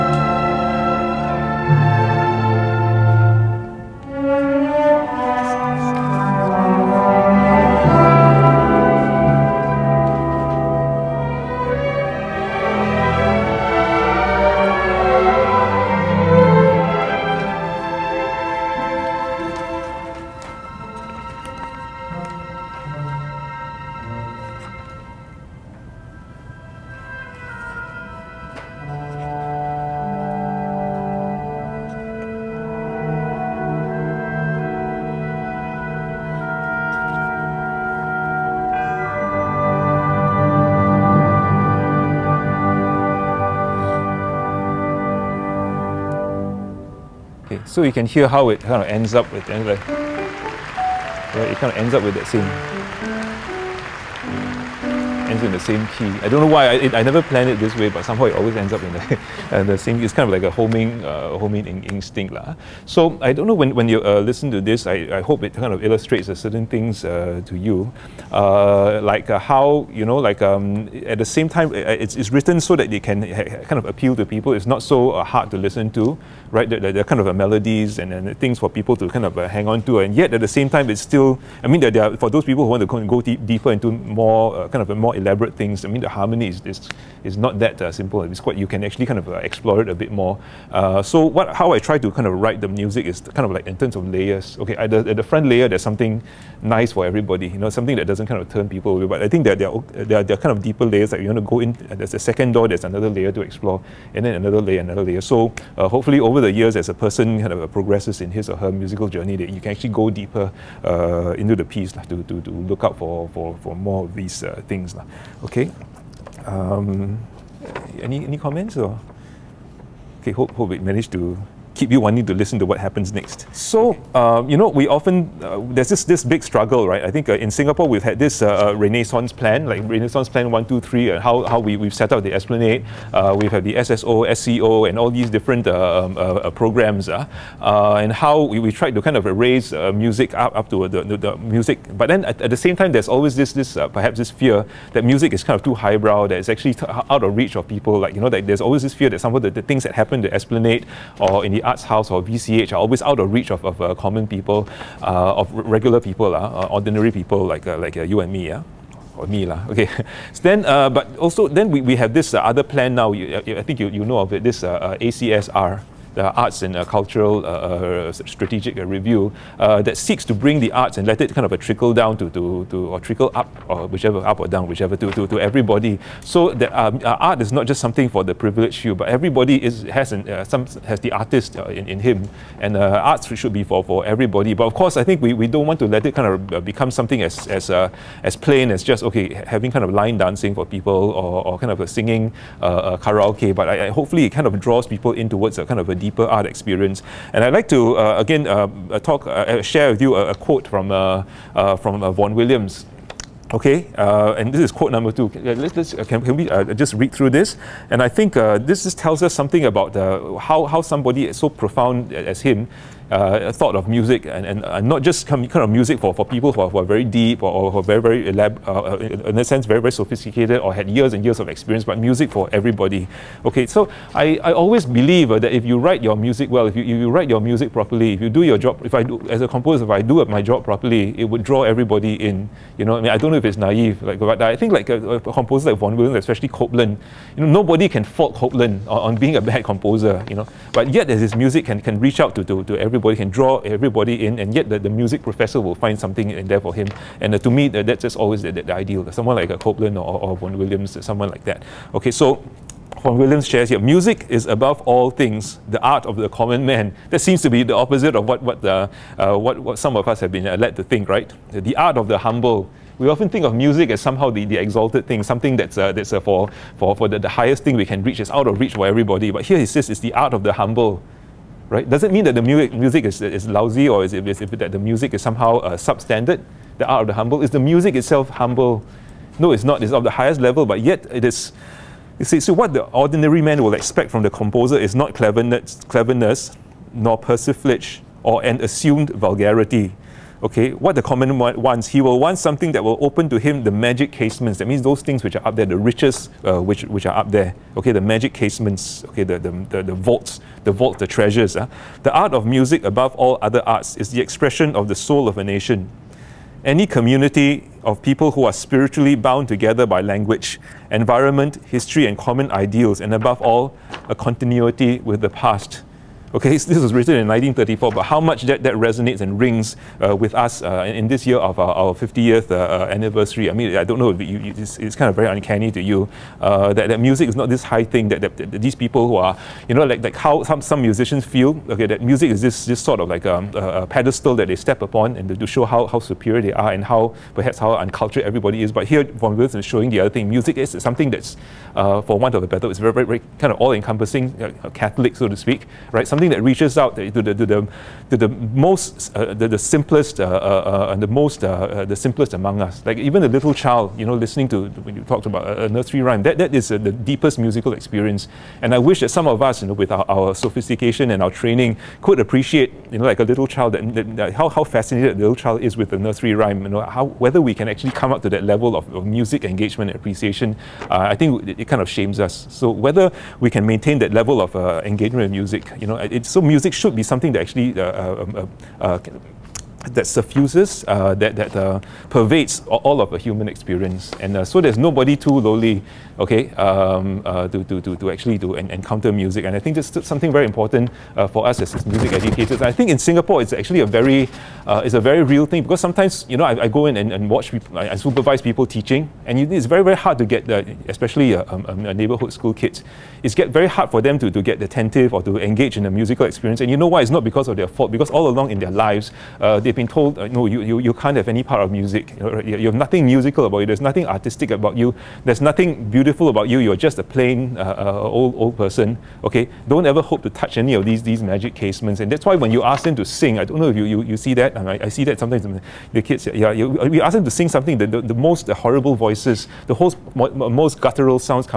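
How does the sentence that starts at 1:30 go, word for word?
Uh, so what, how I try to kind of write the music is kind of like in terms of layers.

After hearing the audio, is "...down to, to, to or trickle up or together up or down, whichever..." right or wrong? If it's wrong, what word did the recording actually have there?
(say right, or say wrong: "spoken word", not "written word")
wrong: "whichever", not "together".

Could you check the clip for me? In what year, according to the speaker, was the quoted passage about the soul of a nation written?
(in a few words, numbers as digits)
1934.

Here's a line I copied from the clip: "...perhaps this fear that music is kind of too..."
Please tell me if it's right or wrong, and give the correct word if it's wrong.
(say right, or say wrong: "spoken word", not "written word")
right.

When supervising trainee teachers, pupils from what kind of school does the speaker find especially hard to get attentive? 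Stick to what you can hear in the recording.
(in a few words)
Neighborhood school.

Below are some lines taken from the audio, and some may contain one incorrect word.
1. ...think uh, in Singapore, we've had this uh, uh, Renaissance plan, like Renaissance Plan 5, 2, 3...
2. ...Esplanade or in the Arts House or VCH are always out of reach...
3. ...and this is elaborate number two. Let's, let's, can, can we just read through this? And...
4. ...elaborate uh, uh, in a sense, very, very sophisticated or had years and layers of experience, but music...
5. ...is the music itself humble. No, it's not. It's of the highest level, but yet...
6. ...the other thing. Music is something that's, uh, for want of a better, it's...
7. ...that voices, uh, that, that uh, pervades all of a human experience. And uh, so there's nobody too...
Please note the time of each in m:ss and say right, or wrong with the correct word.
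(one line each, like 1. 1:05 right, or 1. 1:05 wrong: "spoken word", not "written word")
1. 2:07 wrong: "1", not "5"
2. 2:30 right
3. 3:24 wrong: "quote", not "elaborate"
4. 3:38 wrong: "years", not "layers"
5. 4:37 right
6. 5:39 right
7. 6:19 wrong: "suffuses", not "voices".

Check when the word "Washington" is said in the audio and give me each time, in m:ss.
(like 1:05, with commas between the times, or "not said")
not said.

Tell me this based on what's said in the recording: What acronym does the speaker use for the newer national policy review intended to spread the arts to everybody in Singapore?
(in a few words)
ACSR.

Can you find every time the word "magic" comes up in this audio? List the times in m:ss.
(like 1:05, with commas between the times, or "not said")
4:53, 4:58, 7:01.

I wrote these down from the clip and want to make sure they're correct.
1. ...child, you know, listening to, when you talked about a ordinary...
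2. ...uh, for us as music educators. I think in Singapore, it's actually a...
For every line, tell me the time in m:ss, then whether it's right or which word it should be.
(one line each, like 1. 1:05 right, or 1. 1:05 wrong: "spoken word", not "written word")
1. 5:53 wrong: "nursery", not "ordinary"
2. 6:31 right.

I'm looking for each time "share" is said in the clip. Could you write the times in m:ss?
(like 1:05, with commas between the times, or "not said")
3:19, 4:13.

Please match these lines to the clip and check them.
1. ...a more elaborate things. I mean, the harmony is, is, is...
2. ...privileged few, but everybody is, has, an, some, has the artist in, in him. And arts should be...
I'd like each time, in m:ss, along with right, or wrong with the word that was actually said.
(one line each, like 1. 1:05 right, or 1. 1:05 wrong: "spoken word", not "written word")
1. 1:24 right
2. 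2:58 right.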